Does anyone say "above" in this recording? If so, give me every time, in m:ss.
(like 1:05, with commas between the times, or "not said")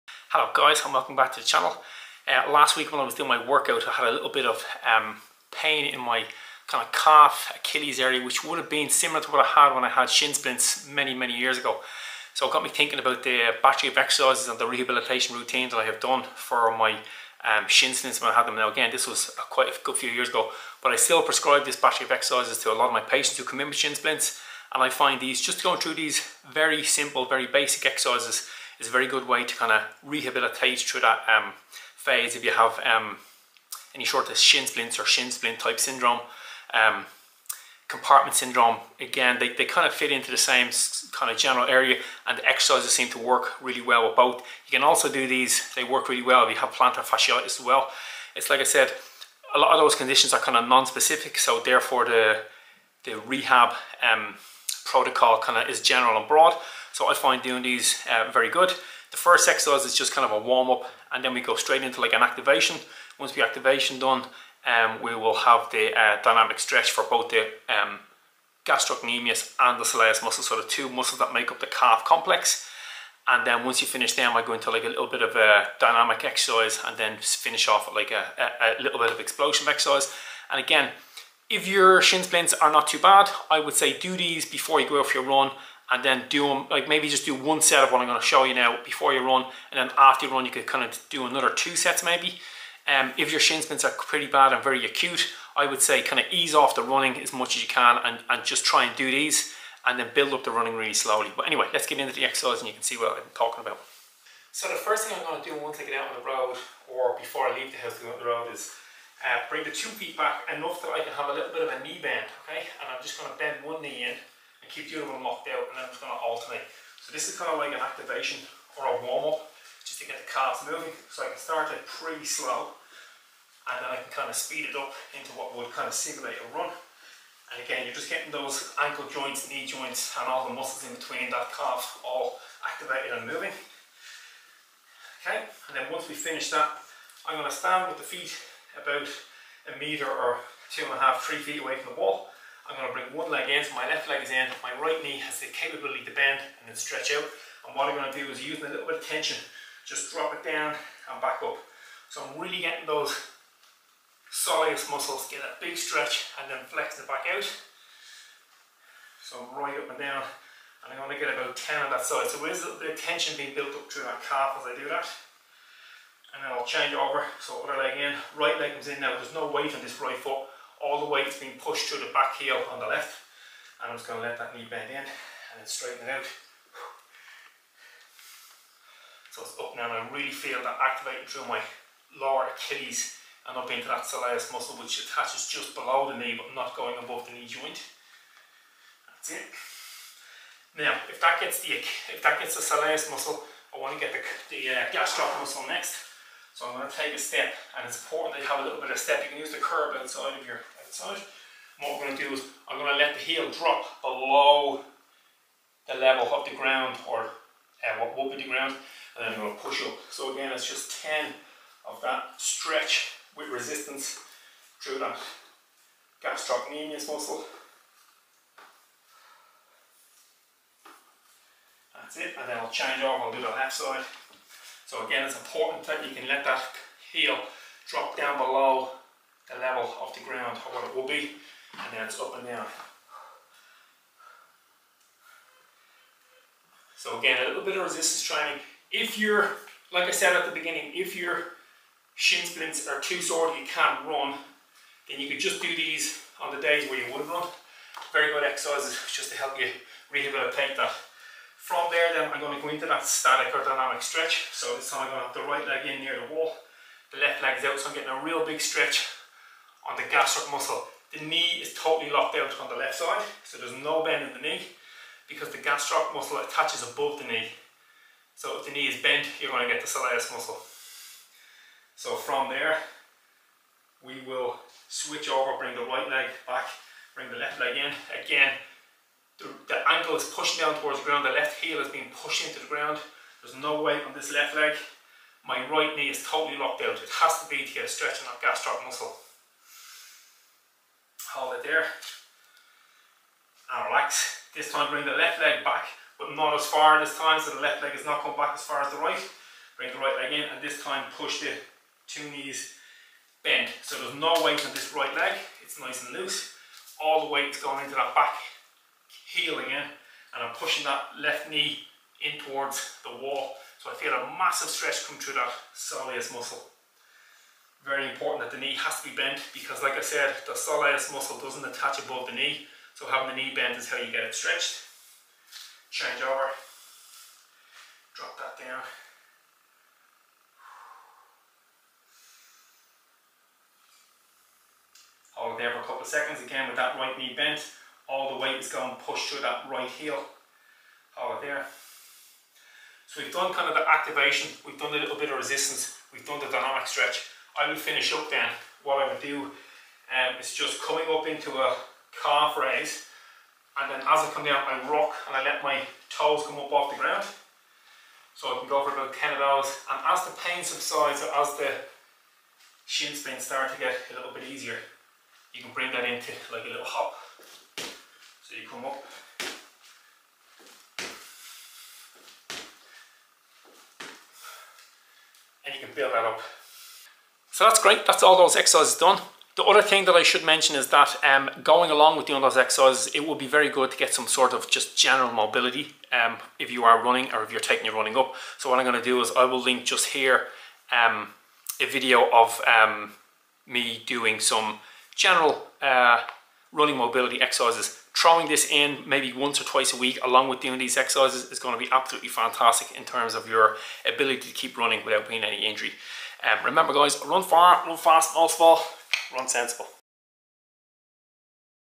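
3:06, 4:26, 5:21.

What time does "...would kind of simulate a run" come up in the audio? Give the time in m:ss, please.
2:05.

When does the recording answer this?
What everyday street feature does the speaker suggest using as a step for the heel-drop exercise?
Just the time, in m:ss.
3:19.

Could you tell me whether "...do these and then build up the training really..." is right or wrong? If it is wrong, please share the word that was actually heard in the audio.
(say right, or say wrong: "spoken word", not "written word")
wrong: "running", not "training".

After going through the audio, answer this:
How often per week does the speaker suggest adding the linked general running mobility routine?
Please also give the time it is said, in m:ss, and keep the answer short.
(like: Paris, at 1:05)
once or twice, at 6:39.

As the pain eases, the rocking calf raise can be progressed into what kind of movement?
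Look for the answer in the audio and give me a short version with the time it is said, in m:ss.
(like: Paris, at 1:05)
a little hop, at 6:06.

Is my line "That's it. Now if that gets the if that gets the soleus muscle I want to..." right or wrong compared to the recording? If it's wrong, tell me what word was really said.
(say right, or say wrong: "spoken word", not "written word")
right.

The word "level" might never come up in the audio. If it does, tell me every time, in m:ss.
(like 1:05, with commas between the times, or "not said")
3:25, 3:49.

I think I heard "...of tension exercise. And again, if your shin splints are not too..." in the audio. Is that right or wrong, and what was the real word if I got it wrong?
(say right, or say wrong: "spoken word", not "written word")
wrong: "explosion", not "tension".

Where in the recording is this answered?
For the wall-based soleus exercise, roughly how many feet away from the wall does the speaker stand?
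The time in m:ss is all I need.
2:21.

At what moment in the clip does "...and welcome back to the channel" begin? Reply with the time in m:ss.
0:00.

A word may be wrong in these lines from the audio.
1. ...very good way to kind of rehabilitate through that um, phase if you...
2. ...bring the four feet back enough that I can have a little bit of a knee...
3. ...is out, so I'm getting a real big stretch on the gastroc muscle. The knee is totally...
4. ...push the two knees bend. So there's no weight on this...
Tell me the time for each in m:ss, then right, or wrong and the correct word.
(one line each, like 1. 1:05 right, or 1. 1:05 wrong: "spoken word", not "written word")
1. 0:28 right
2. 1:49 wrong: "two", not "four"
3. 4:17 right
4. 5:01 right.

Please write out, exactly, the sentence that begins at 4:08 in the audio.
Very good exercises just to help you rehabilitate that.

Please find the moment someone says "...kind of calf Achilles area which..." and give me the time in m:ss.
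0:06.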